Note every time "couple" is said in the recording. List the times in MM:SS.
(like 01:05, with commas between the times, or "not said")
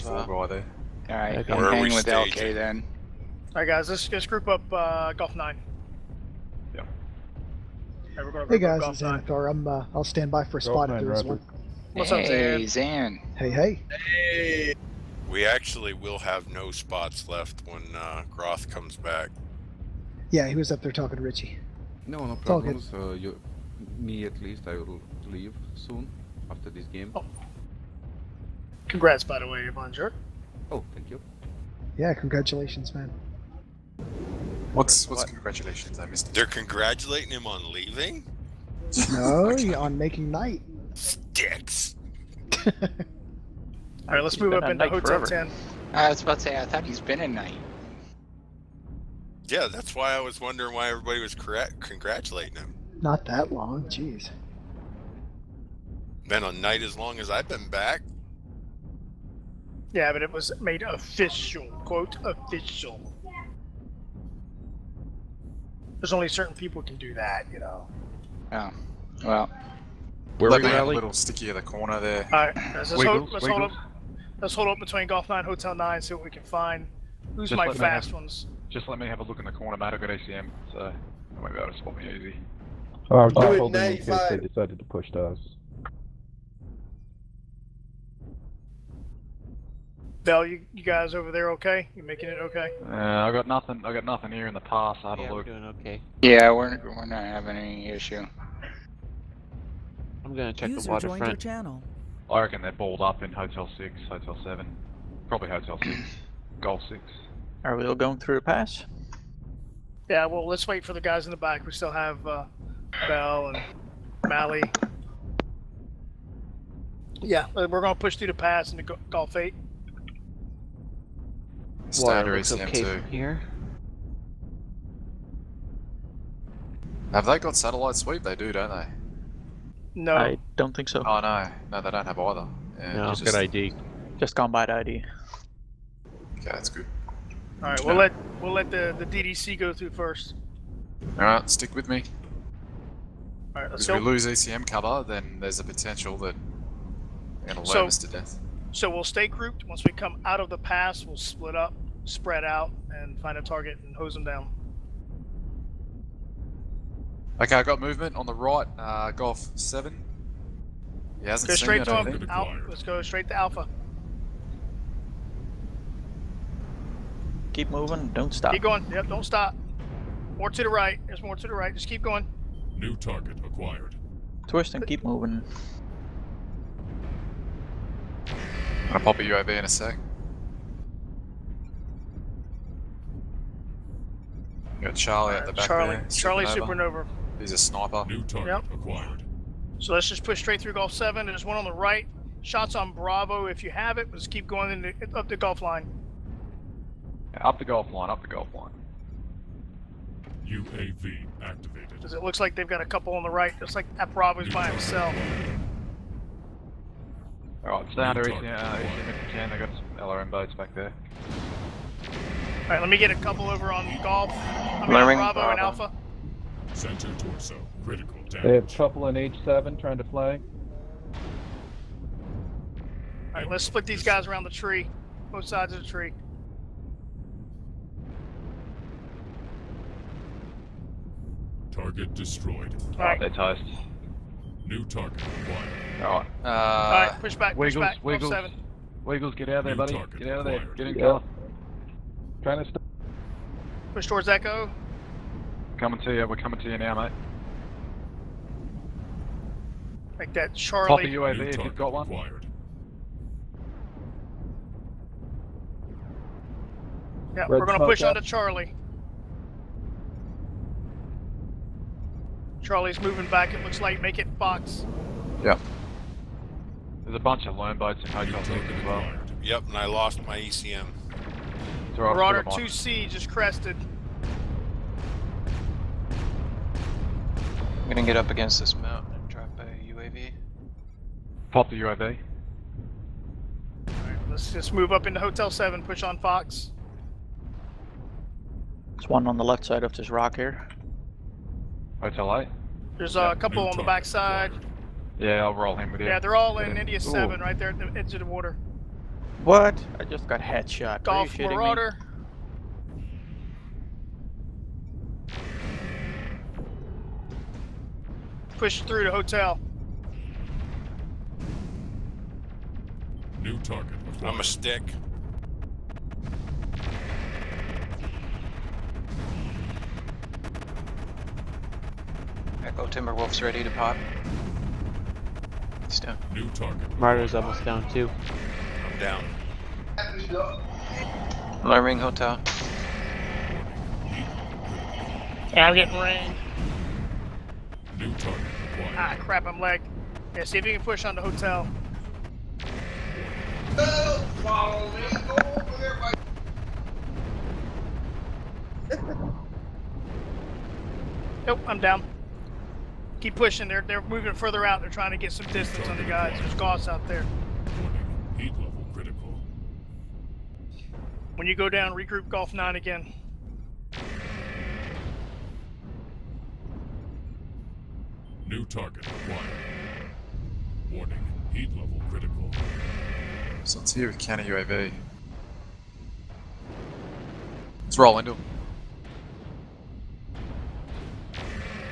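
03:22, 03:33, 04:53.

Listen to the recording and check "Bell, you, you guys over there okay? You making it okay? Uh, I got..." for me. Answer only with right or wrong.
right.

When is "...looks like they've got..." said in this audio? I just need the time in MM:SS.
03:22.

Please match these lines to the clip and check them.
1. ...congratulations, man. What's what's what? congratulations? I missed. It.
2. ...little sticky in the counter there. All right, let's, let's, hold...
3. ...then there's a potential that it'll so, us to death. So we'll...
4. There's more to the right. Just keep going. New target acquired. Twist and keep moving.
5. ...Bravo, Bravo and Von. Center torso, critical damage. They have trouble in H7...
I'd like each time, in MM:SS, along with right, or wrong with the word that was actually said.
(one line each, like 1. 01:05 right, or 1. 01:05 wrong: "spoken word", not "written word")
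1. 00:32 right
2. 01:10 wrong: "corner", not "counter"
3. 02:25 right
4. 02:51 right
5. 03:34 wrong: "Alpha", not "Von".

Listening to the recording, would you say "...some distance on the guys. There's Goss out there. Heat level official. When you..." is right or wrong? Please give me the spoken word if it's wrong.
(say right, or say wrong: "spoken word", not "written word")
wrong: "critical", not "official".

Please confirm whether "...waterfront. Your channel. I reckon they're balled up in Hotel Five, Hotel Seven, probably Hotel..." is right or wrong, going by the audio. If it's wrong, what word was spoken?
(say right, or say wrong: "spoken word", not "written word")
wrong: "Six", not "Five".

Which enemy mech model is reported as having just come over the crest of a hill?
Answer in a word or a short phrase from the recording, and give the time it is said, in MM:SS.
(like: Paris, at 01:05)
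Marauder 2C, at 04:31.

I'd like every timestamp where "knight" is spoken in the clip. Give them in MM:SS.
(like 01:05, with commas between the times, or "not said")
00:40, 00:47, 00:56.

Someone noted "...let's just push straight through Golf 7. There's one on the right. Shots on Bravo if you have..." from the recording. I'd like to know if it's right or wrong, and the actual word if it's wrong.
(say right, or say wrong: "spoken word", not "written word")
right.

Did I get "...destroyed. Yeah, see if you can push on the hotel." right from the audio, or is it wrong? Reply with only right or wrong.
wrong.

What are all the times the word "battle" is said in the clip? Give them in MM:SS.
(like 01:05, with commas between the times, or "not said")
not said.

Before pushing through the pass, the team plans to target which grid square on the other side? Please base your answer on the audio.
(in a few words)
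Golf 8.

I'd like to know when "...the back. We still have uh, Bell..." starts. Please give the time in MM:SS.
01:51.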